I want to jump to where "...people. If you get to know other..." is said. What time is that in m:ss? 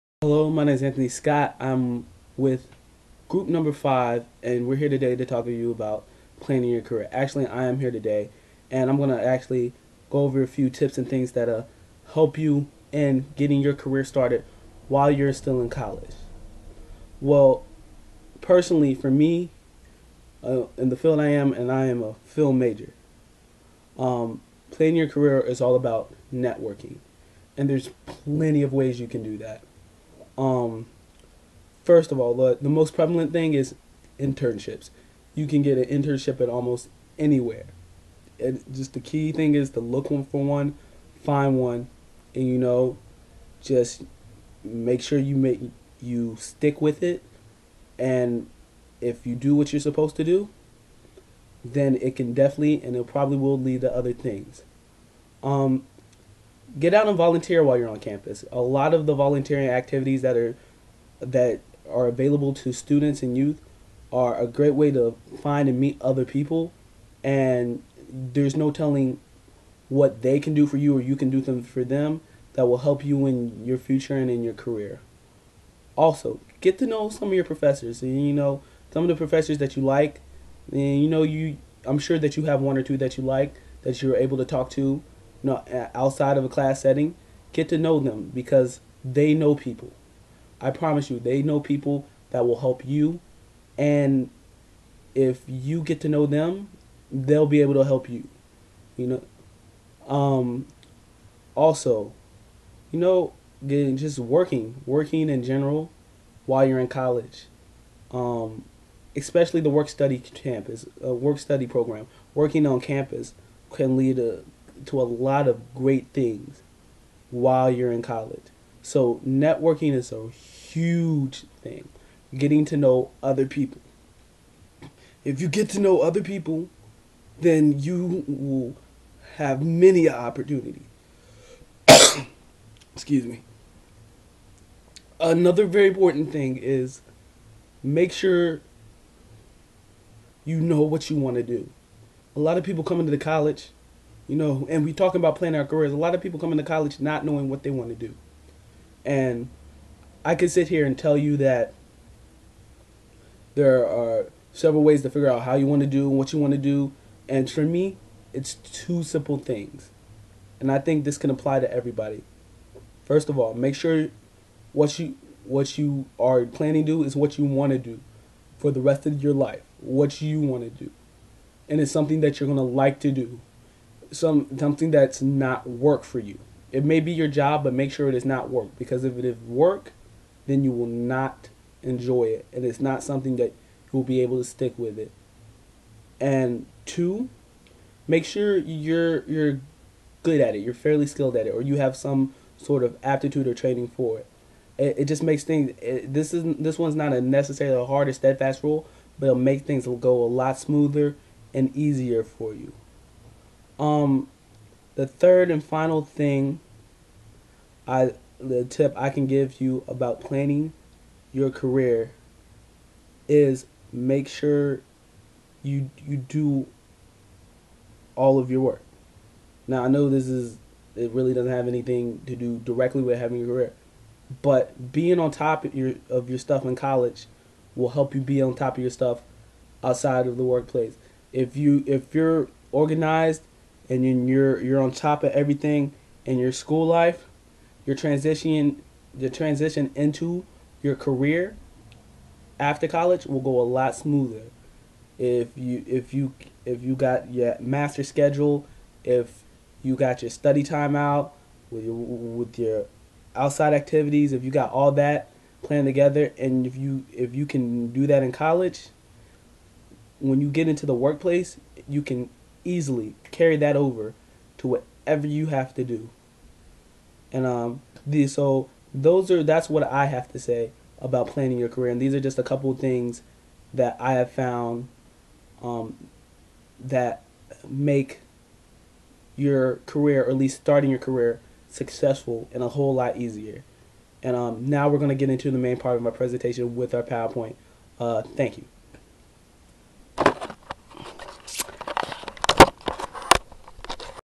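2:03.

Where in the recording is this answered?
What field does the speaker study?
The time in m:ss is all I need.
0:22.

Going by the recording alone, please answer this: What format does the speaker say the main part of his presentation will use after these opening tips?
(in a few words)
PowerPoint.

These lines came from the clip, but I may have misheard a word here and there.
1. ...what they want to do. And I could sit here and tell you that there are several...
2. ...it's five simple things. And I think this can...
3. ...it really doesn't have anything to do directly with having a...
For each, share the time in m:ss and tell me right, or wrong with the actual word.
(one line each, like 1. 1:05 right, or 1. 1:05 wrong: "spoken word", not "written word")
1. 2:27 right
2. 2:38 wrong: "two", not "five"
3. 3:40 right.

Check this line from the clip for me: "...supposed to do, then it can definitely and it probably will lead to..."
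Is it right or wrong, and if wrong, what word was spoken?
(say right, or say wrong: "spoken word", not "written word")
right.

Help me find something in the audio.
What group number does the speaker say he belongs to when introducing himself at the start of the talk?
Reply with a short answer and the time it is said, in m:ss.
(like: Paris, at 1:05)
5, at 0:03.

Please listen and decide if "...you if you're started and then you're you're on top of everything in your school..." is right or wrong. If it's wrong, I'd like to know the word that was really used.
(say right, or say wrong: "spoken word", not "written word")
wrong: "organized", not "started".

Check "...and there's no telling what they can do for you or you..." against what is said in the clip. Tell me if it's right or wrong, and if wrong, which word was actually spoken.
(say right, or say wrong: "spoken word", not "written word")
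right.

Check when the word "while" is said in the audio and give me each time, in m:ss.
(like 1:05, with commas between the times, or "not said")
0:14, 0:57, 1:46, 1:57.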